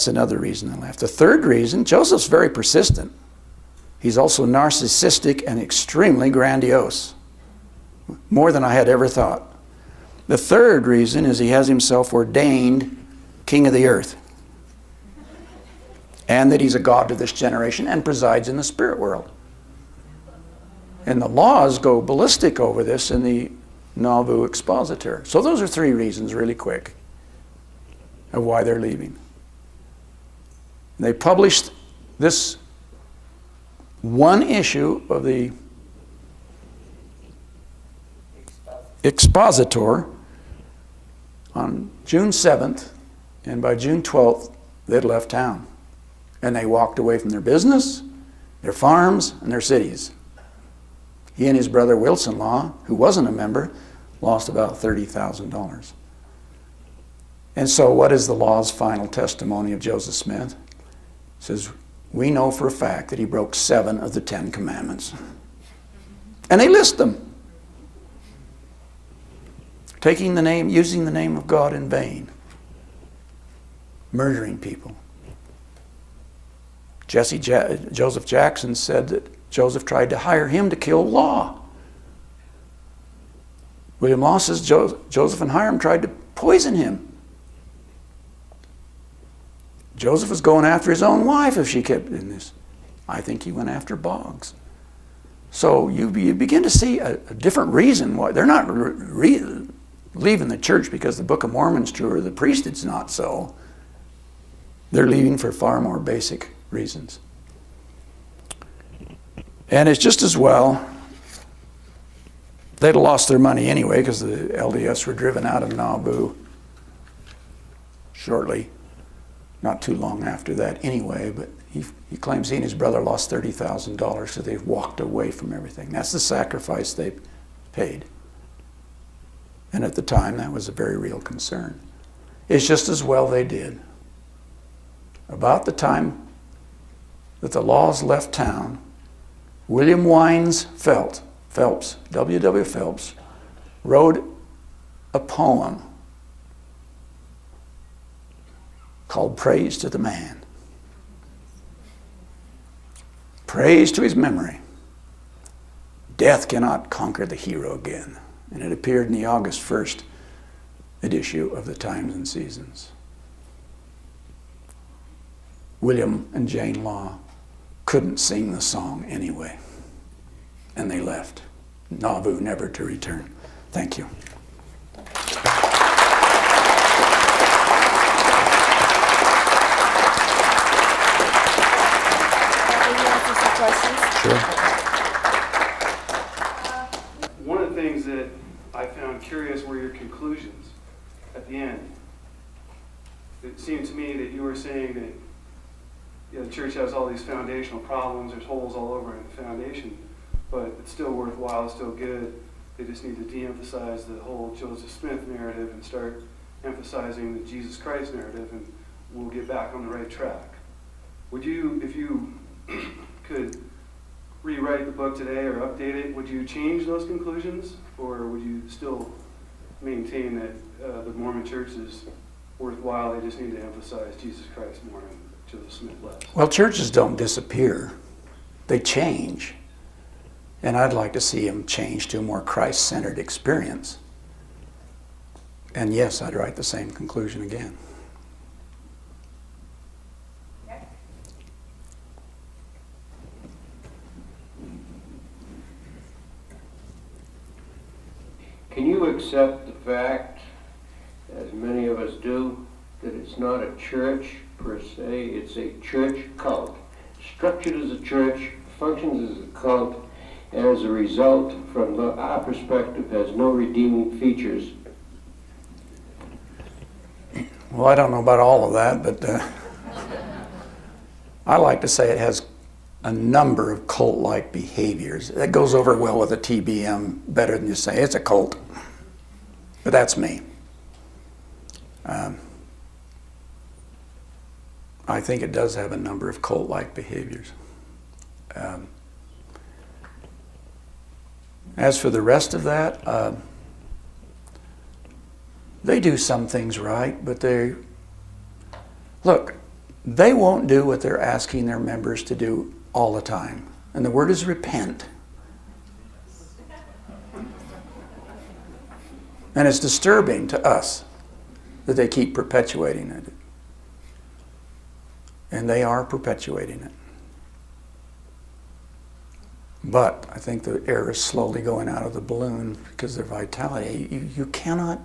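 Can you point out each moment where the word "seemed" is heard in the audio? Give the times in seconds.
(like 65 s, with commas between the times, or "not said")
193 s.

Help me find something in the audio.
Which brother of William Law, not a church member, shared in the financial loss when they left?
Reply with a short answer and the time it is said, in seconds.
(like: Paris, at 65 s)
Wilson Law, at 51 s.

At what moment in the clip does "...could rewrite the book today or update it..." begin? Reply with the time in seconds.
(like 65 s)
213 s.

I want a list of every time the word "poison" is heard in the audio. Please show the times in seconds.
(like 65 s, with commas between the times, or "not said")
86 s.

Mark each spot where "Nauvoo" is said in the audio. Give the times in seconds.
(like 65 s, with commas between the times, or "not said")
23 s, 115 s, 171 s.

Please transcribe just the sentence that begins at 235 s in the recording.
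And yes, I'd write the same conclusion again.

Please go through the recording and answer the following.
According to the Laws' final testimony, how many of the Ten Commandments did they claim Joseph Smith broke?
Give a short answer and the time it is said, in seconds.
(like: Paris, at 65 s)
7, at 63 s.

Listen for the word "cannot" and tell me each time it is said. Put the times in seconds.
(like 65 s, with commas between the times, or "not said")
156 s, 324 s.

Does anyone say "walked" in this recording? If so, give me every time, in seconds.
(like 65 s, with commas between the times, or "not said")
46 s, 124 s.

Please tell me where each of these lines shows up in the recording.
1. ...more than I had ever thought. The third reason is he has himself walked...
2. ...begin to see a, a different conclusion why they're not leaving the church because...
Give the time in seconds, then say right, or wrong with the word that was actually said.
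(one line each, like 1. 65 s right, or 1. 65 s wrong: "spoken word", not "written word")
1. 8 s wrong: "ordained", not "walked"
2. 96 s wrong: "reason", not "conclusion".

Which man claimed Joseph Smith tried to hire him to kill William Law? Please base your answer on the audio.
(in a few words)
Joseph Jackson.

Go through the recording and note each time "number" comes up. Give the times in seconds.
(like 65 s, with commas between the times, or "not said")
273 s, 285 s.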